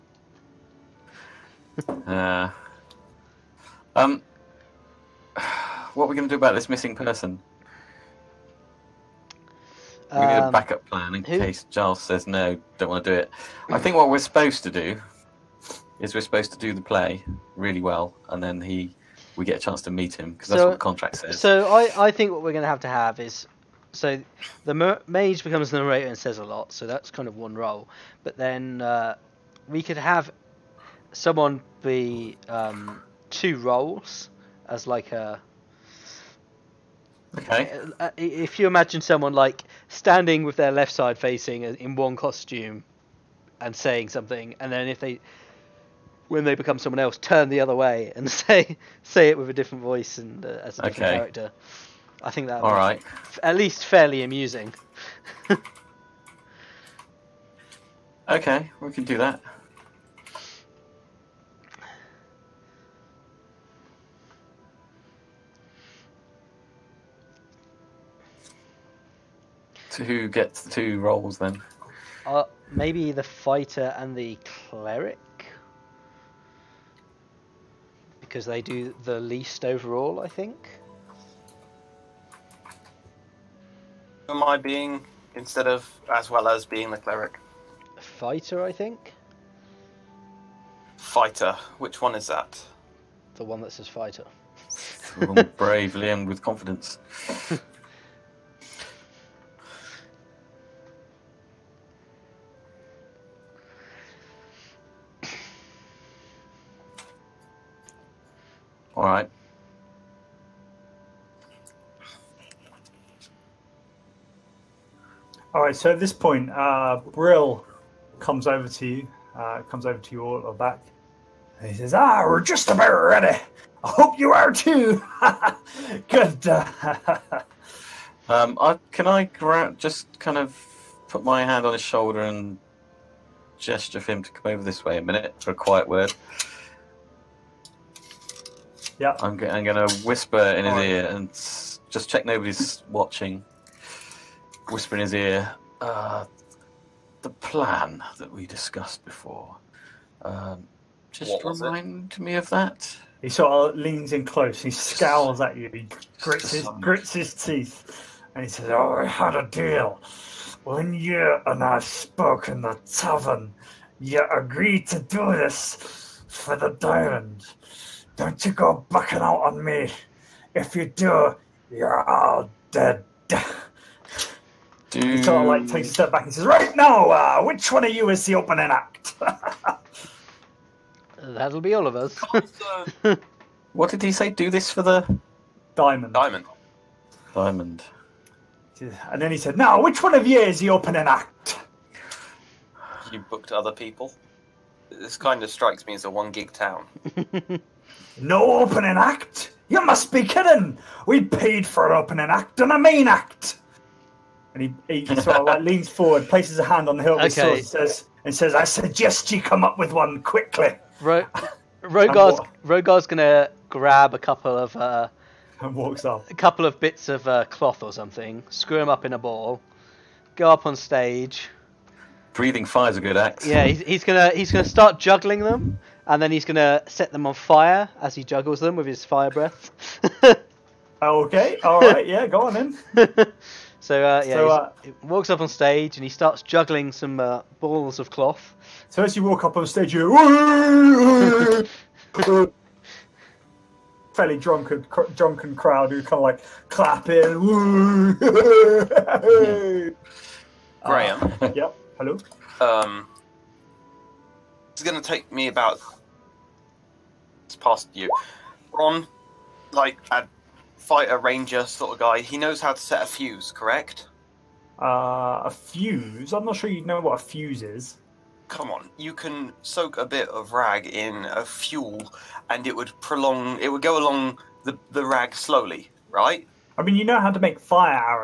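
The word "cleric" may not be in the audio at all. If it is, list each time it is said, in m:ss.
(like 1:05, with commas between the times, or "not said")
1:14, 1:26.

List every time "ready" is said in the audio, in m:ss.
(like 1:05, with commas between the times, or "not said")
2:02.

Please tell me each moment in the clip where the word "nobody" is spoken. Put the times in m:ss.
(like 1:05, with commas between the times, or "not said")
2:22.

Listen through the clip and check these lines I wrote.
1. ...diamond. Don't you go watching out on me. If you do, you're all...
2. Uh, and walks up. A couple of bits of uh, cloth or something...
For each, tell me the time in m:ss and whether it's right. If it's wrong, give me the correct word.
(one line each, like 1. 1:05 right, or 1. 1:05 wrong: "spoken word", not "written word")
1. 2:46 wrong: "bucking", not "watching"
2. 3:34 right.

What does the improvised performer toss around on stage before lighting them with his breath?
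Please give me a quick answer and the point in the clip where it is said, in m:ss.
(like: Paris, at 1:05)
Balls of cloth, at 3:57.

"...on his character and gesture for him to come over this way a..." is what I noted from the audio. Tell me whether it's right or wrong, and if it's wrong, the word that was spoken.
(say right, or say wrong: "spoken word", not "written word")
wrong: "shoulder", not "character".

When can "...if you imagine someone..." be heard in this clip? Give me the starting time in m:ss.
0:38.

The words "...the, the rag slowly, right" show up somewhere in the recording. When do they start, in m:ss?
4:34.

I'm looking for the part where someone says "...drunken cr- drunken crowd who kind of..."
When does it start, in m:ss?
4:04.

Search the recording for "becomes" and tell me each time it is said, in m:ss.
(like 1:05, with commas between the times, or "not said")
0:25, 0:46.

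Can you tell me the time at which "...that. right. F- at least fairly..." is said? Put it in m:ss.
0:52.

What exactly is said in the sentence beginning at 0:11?
case Giles says no, don't want to do it.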